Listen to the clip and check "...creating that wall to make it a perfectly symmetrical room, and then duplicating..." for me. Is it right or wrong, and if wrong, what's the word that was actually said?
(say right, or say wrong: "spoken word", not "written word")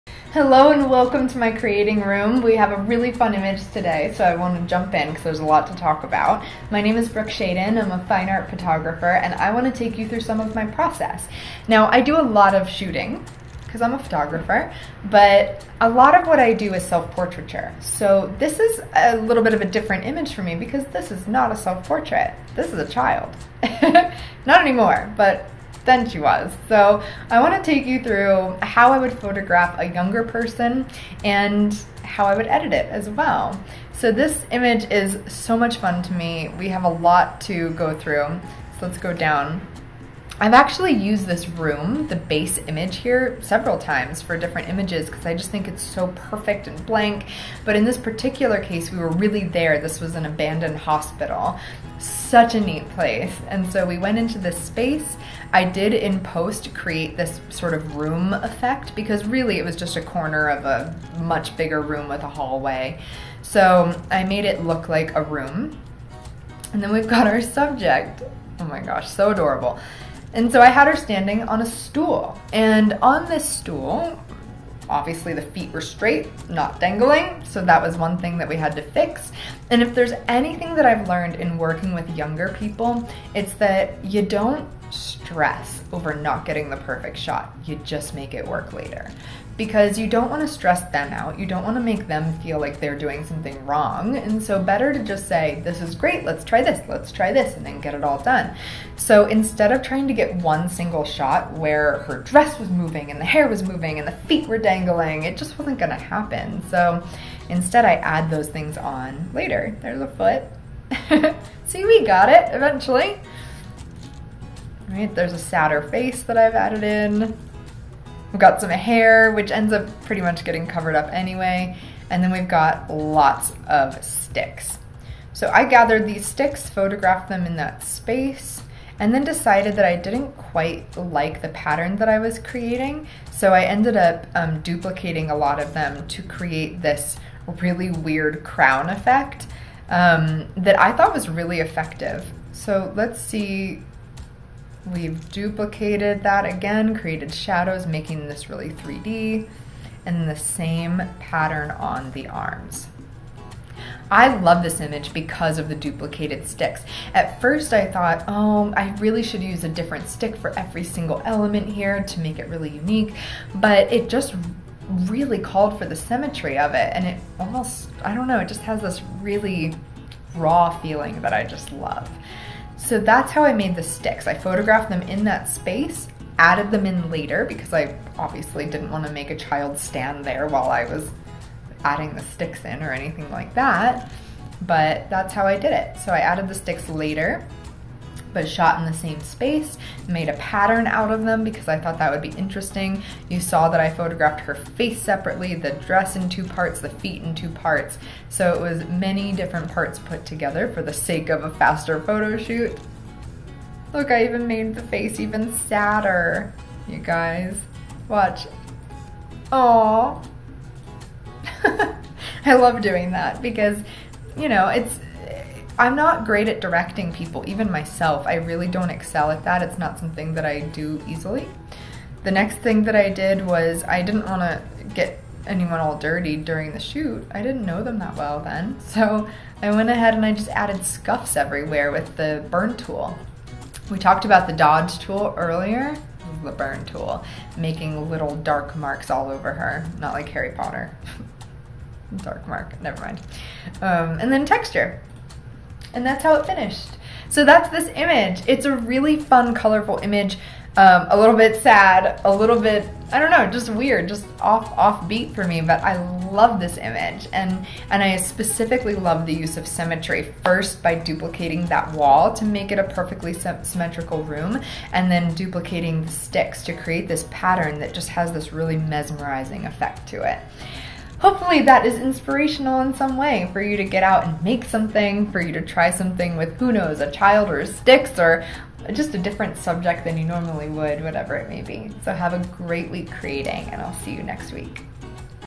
wrong: "duplicating", not "creating".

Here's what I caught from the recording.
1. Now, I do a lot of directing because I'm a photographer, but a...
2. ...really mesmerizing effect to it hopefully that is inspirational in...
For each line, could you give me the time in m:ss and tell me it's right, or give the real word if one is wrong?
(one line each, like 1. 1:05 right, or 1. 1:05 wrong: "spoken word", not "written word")
1. 0:11 wrong: "shooting", not "directing"
2. 4:28 right.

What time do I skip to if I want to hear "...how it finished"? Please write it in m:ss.
4:06.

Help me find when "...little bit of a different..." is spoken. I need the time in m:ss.
0:19.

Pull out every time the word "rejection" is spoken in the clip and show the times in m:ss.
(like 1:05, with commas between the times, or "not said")
not said.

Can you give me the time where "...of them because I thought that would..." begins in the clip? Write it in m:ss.
3:11.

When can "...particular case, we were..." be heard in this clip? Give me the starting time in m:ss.
0:47.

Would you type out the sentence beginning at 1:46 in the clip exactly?
So, Instead, I add those things on later.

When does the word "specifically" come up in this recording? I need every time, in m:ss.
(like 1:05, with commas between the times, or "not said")
4:18.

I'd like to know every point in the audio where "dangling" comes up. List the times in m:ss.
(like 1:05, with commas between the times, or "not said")
1:16, 1:44.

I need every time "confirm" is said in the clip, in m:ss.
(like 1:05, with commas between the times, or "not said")
not said.